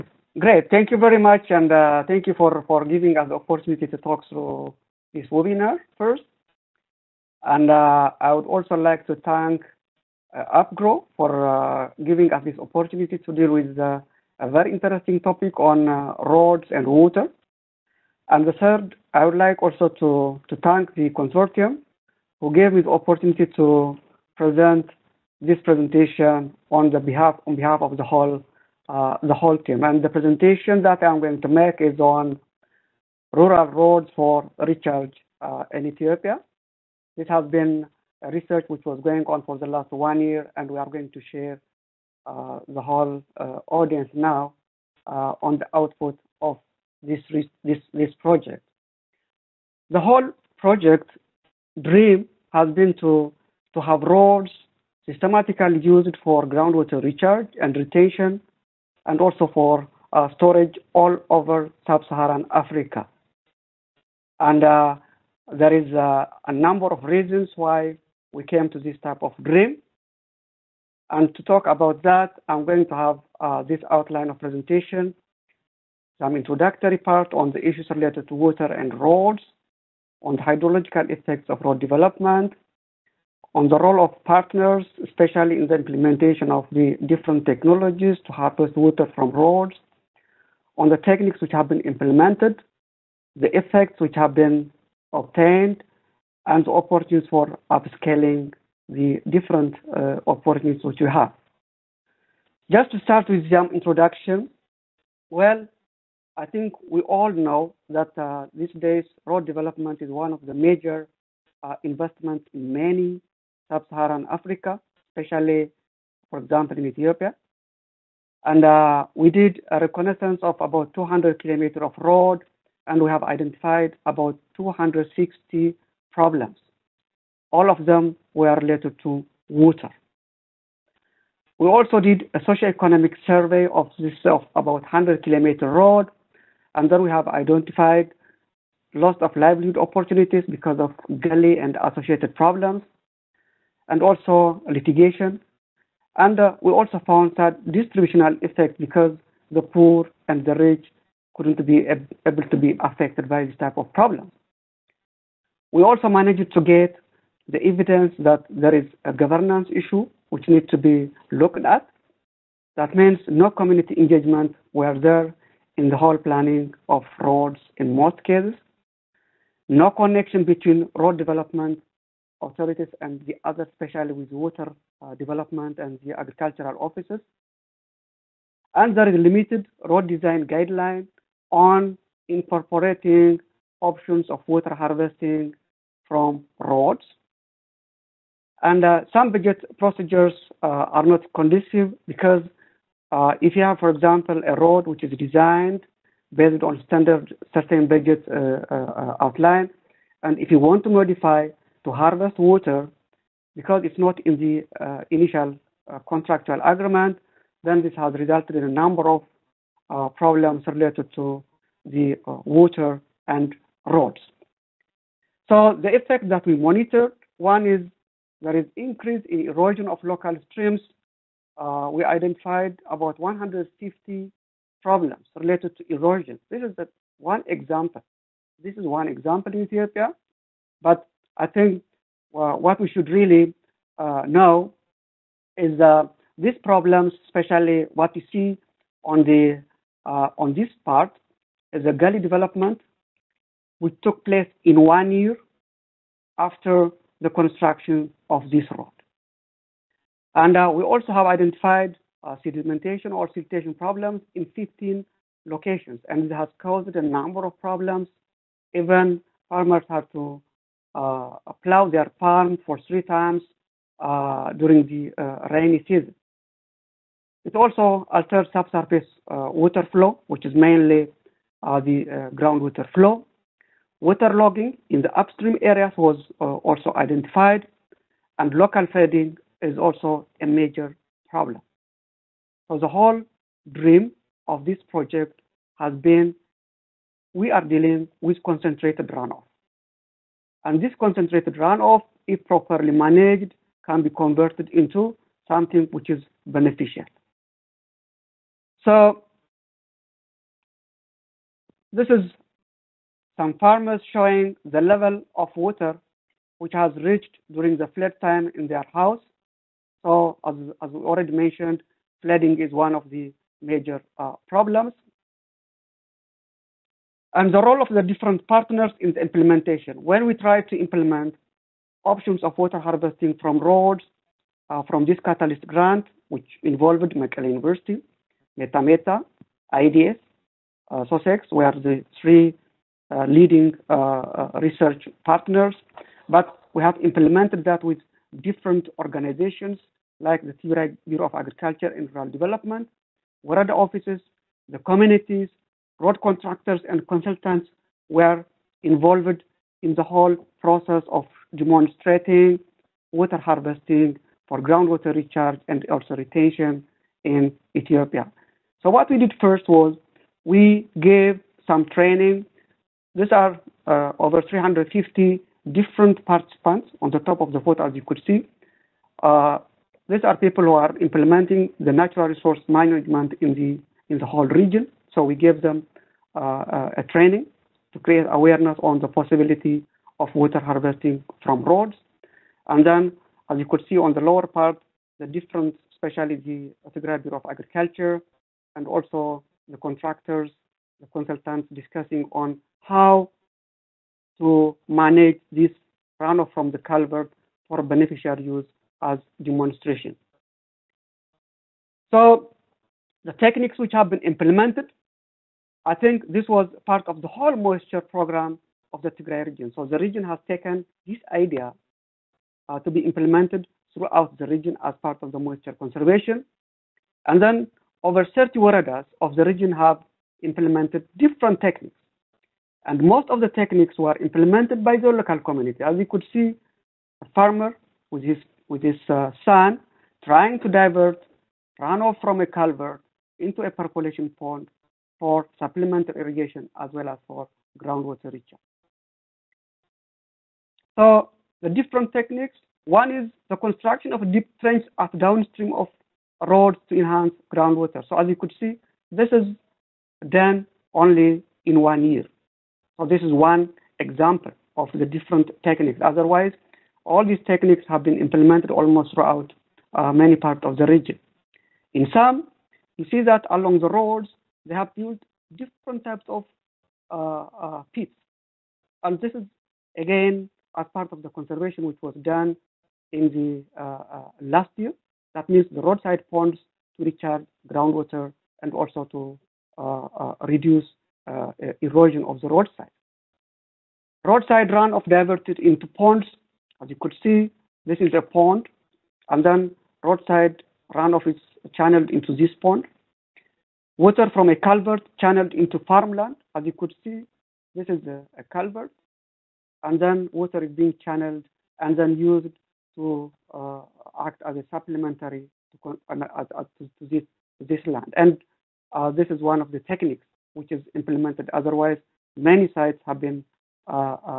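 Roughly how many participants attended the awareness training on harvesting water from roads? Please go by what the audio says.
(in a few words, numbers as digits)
350.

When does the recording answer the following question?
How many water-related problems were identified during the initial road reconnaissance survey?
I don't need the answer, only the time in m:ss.
2:04.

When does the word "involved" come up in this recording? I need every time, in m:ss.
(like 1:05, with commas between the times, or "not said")
5:26, 5:48.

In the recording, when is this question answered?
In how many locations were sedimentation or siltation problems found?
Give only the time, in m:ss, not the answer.
4:14.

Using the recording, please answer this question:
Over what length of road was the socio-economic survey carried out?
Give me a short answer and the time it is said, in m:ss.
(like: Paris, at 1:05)
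100 kilometers, at 2:14.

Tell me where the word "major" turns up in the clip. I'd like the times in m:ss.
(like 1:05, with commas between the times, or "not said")
1:50, 4:40, 5:13.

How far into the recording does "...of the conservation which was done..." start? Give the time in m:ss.
7:51.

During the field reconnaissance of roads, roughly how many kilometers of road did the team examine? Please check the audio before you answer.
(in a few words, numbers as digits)
200.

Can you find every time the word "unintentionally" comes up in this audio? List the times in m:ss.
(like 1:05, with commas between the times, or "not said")
not said.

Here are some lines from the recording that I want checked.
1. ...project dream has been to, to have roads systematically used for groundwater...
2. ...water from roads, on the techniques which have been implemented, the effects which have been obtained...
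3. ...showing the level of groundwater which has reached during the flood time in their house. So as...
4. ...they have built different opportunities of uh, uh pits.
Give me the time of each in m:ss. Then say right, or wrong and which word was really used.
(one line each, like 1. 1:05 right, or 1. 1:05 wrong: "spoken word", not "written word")
1. 0:50 right
2. 1:28 right
3. 5:04 wrong: "water", not "groundwater"
4. 7:44 wrong: "types", not "opportunities".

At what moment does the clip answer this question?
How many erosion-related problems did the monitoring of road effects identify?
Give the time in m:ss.
3:43.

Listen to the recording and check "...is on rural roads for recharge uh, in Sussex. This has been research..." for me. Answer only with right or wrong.
wrong.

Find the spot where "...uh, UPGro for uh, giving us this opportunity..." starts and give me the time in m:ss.
0:10.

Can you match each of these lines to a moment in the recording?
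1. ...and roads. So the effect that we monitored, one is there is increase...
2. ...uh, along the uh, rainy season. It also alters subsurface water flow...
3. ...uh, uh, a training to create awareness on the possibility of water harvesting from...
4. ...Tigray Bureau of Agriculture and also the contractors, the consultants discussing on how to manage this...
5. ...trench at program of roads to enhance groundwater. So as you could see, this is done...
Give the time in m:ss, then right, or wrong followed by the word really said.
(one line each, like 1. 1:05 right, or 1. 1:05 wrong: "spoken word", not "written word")
1. 3:33 right
2. 4:23 wrong: "during", not "along"
3. 6:16 right
4. 6:26 right
5. 7:24 wrong: "downstream", not "program".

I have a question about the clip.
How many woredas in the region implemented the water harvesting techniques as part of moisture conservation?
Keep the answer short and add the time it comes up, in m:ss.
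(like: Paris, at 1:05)
over 30, at 6:58.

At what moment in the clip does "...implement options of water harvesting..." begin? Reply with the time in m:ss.
5:20.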